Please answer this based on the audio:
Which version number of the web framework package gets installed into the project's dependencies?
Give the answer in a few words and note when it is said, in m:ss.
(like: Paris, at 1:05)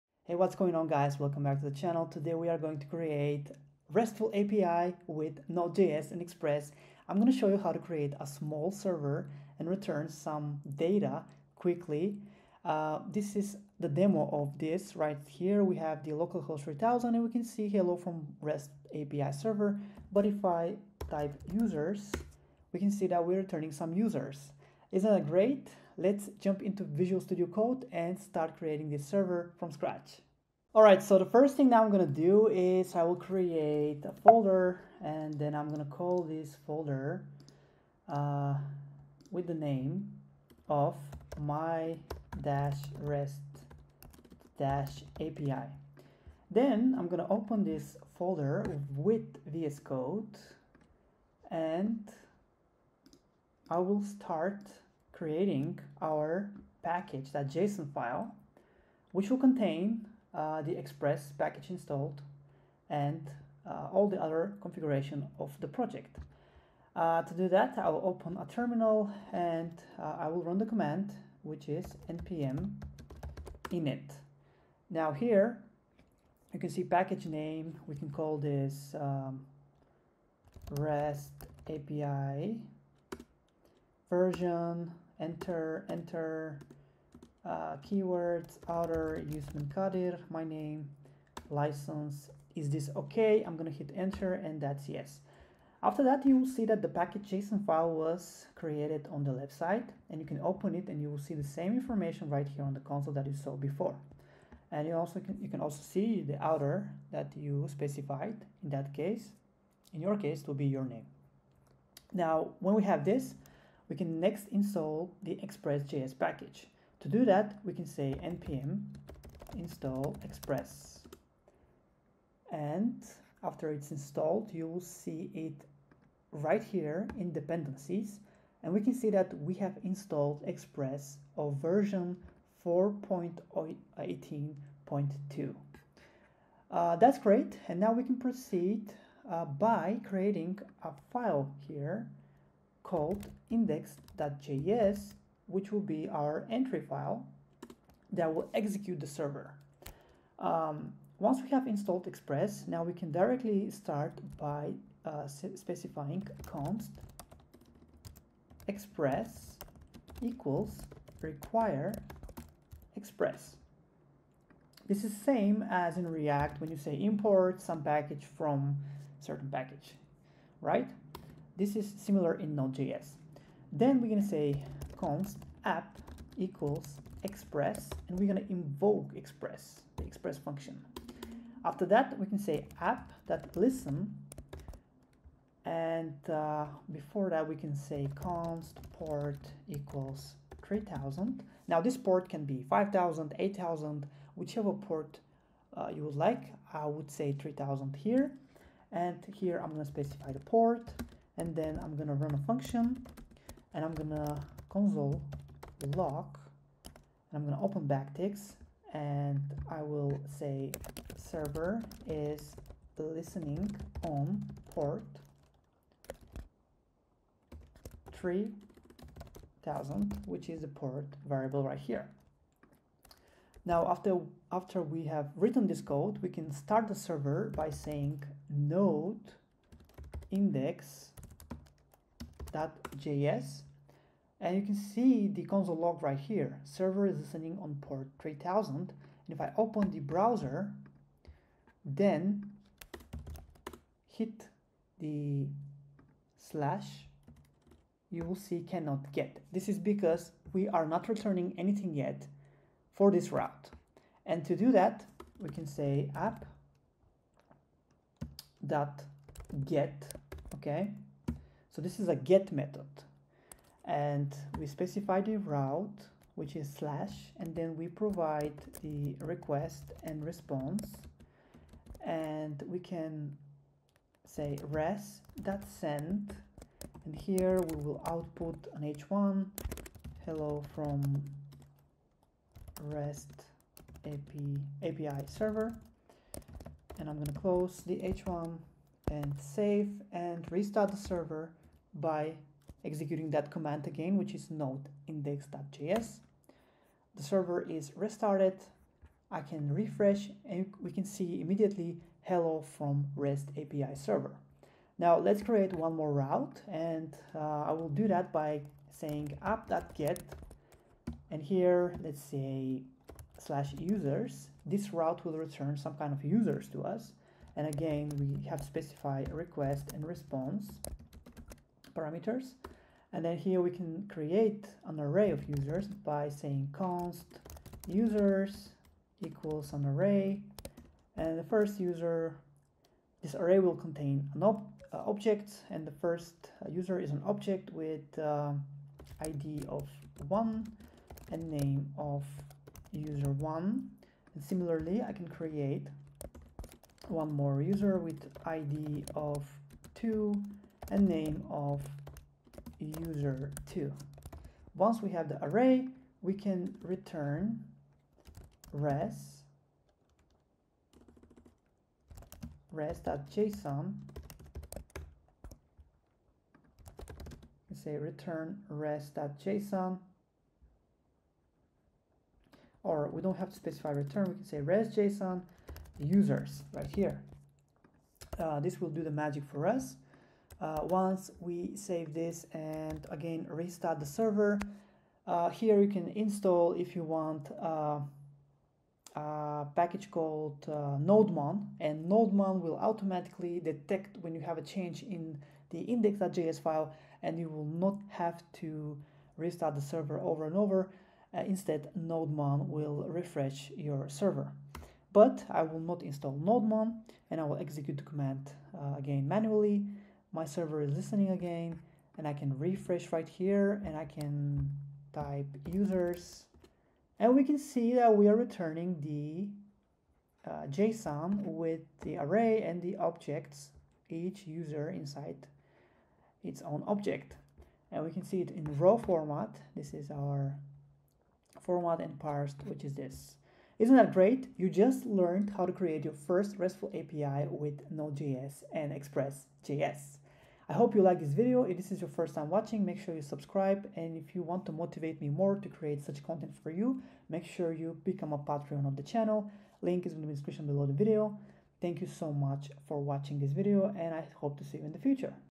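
4.18.2, at 2:12.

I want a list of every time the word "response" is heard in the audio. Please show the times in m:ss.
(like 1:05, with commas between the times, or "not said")
4:30, 5:20.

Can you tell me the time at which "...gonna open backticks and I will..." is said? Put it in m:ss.
3:27.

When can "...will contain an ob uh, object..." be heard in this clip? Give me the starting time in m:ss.
5:33.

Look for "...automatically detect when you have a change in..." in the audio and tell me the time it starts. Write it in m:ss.
6:32.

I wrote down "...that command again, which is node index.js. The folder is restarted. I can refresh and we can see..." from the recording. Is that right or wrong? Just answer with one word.
wrong.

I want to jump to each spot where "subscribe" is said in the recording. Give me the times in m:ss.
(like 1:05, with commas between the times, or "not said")
7:23.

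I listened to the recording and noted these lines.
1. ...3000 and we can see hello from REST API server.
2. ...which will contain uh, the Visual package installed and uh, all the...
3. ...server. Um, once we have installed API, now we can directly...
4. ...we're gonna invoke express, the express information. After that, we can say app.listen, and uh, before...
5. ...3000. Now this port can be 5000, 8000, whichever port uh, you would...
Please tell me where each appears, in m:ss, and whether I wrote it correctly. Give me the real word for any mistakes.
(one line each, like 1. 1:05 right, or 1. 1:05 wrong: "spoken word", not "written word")
1. 0:16 right
2. 0:59 wrong: "Express", not "Visual"
3. 2:29 wrong: "Express", not "API"
4. 2:58 wrong: "function", not "information"
5. 3:10 right.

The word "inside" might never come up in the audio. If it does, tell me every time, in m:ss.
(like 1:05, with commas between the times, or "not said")
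7:04.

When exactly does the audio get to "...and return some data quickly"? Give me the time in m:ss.
0:09.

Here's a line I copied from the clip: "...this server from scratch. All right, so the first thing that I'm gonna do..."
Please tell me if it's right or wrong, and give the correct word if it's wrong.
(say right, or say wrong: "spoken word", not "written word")
right.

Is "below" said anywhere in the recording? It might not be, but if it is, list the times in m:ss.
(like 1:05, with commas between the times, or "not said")
7:30.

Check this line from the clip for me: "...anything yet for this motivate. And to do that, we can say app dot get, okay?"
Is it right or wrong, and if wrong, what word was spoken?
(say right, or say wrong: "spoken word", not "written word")
wrong: "route", not "motivate".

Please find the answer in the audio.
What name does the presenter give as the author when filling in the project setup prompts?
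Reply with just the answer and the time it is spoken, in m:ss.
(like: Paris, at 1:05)
Yusman Kadir, at 1:29.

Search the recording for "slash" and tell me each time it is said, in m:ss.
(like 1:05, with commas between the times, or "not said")
4:06, 4:26, 5:13.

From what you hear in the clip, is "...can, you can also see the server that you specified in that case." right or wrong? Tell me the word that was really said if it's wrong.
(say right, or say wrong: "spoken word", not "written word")
wrong: "outer", not "server".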